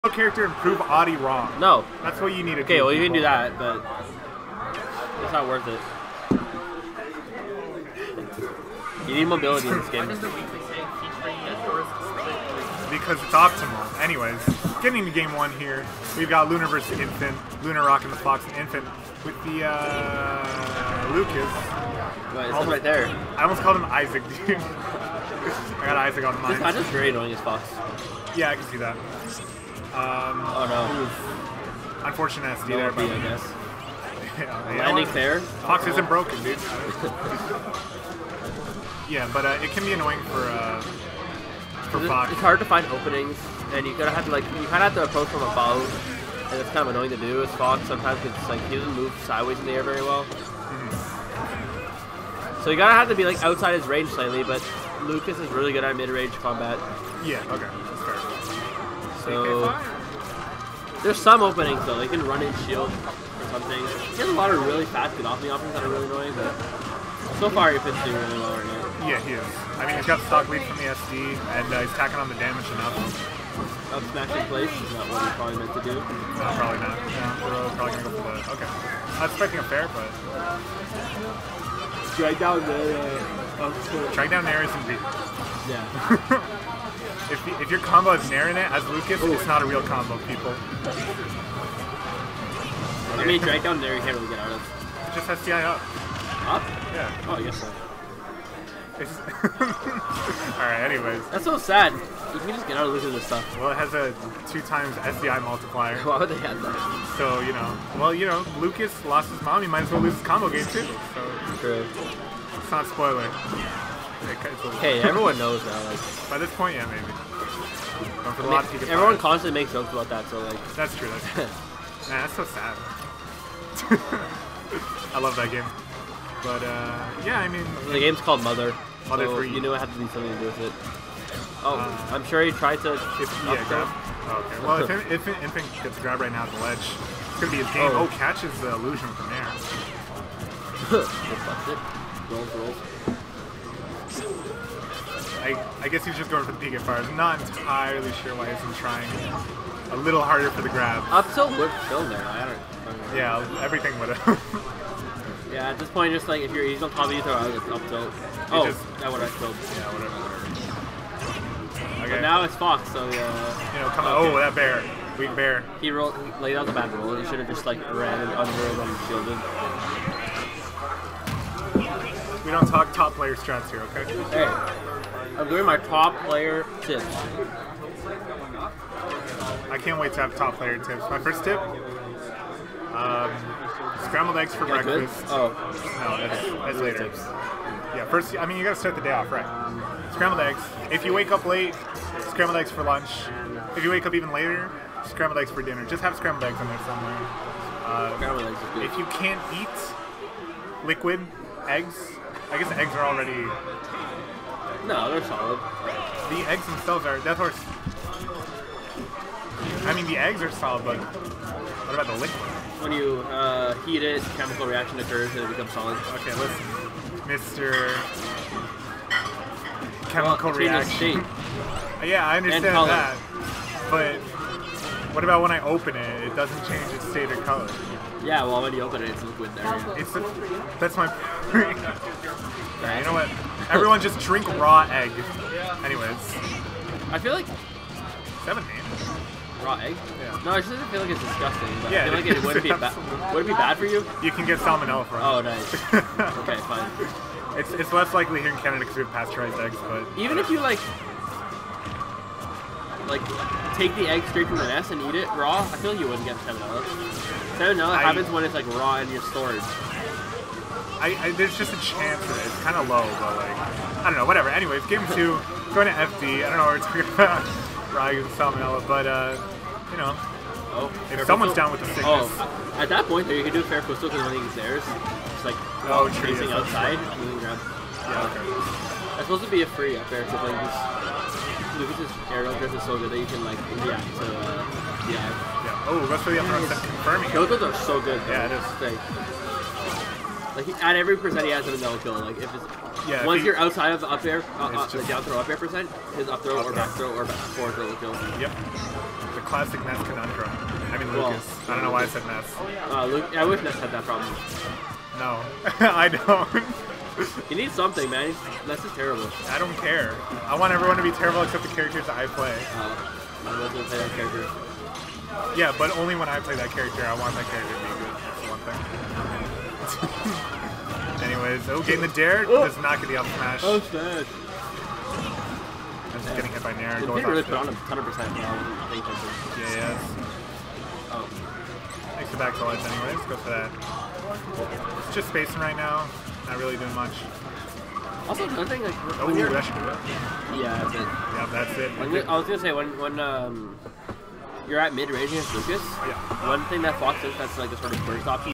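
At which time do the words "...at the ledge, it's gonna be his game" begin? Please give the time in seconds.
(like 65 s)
136 s.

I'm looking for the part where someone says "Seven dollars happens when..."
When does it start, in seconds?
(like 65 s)
257 s.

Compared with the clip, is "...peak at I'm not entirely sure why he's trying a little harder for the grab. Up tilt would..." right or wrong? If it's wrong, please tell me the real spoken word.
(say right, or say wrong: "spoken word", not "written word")
right.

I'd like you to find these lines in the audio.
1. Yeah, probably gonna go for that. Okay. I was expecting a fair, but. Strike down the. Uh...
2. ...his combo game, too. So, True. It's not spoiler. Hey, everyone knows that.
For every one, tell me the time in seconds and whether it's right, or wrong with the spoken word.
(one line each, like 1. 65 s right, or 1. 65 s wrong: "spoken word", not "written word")
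1. 76 s right
2. 110 s right.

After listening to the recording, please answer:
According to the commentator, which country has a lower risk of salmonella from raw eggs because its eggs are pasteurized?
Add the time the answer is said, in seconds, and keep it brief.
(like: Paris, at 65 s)
Canada, at 248 s.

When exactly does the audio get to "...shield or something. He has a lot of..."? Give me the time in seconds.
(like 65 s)
62 s.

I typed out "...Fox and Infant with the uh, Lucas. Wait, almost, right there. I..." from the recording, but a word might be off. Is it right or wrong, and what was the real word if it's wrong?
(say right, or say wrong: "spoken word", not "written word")
right.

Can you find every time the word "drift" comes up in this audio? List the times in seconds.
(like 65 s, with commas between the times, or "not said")
282 s.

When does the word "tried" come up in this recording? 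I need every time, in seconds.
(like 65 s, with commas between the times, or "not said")
132 s.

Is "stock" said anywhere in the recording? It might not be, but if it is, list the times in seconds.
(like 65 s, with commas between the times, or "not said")
70 s.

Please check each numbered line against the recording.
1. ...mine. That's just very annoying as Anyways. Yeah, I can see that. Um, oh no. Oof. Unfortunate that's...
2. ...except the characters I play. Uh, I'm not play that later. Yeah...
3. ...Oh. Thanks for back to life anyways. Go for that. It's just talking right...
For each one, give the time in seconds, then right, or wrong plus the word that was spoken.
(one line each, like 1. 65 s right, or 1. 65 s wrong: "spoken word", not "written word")
1. 26 s wrong: "Fox", not "Anyways"
2. 311 s wrong: "character", not "later"
3. 331 s wrong: "spacing", not "talking".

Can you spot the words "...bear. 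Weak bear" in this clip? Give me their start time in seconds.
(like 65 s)
164 s.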